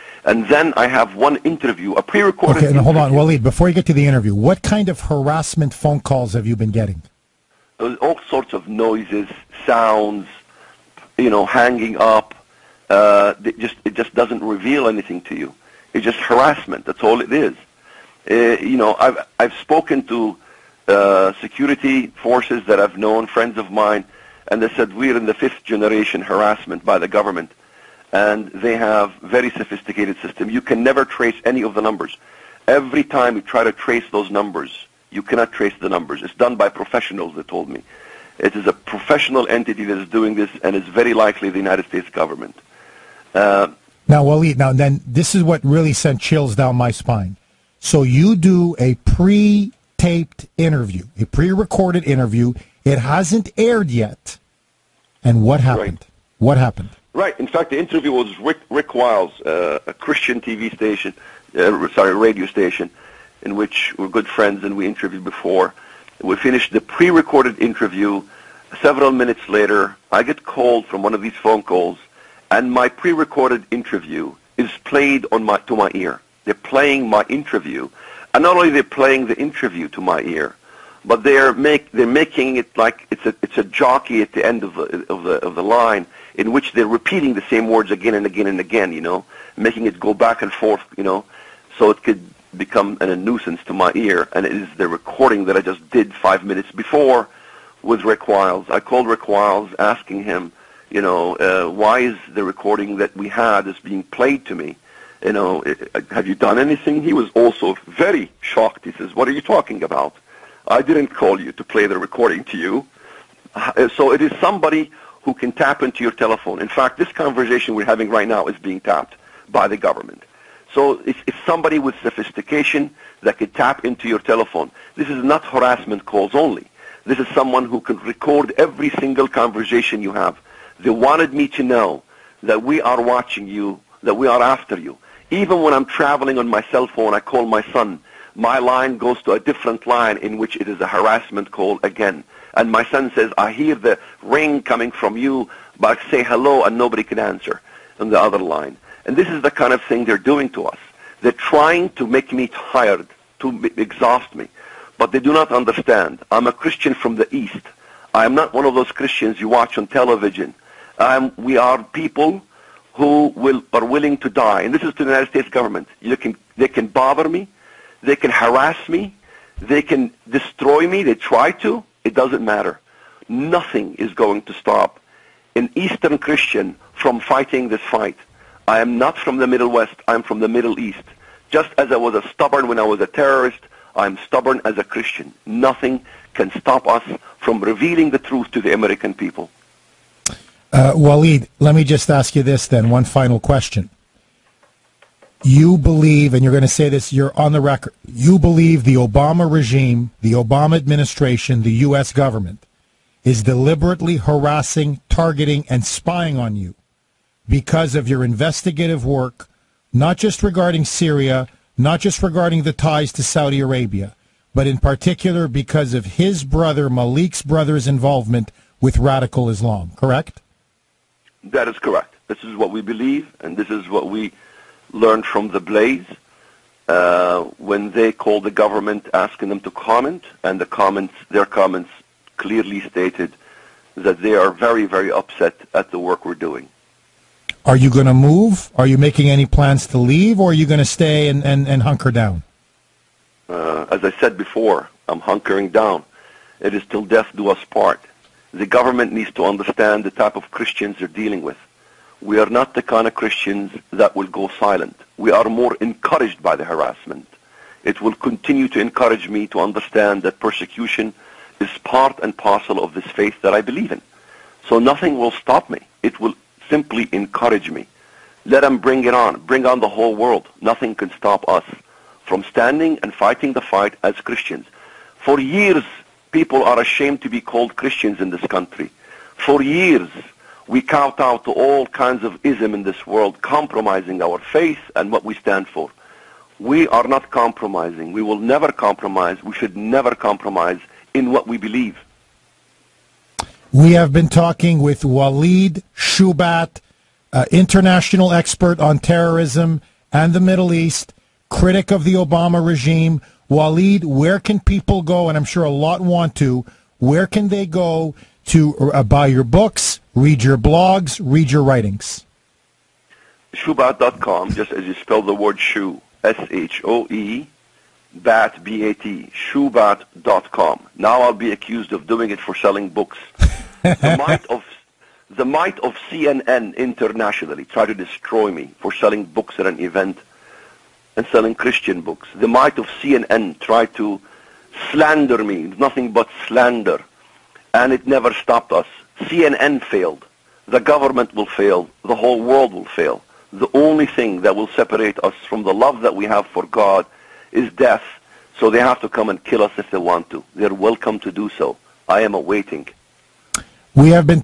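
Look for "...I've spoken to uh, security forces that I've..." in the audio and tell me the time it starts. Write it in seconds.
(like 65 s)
19 s.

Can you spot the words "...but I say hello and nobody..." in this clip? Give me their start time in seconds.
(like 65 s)
145 s.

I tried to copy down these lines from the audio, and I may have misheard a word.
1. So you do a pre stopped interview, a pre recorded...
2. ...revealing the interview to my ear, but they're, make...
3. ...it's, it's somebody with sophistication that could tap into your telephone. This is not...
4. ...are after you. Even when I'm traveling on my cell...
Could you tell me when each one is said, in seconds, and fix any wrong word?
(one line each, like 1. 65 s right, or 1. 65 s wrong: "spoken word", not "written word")
1. 47 s wrong: "taped", not "stopped"
2. 78 s wrong: "playing", not "revealing"
3. 121 s right
4. 134 s right.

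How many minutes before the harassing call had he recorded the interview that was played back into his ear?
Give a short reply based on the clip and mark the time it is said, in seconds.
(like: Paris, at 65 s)
5, at 96 s.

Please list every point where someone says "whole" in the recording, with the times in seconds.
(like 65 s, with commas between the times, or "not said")
269 s, 342 s.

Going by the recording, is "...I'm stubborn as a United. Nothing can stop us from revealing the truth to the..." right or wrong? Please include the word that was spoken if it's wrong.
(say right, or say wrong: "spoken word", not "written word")
wrong: "Christian", not "United".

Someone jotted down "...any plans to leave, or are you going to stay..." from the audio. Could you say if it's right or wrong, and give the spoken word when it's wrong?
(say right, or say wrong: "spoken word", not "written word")
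right.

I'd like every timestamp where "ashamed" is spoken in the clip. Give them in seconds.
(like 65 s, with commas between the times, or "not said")
276 s.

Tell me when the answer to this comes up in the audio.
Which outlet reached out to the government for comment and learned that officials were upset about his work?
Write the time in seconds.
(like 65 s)
225 s.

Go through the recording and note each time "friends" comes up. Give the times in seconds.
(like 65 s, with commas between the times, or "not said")
23 s, 64 s.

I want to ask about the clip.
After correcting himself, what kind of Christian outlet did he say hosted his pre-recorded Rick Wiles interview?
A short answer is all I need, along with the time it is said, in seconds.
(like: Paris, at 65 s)
radio station, at 62 s.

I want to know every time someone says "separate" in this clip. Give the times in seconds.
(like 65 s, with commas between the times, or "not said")
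344 s.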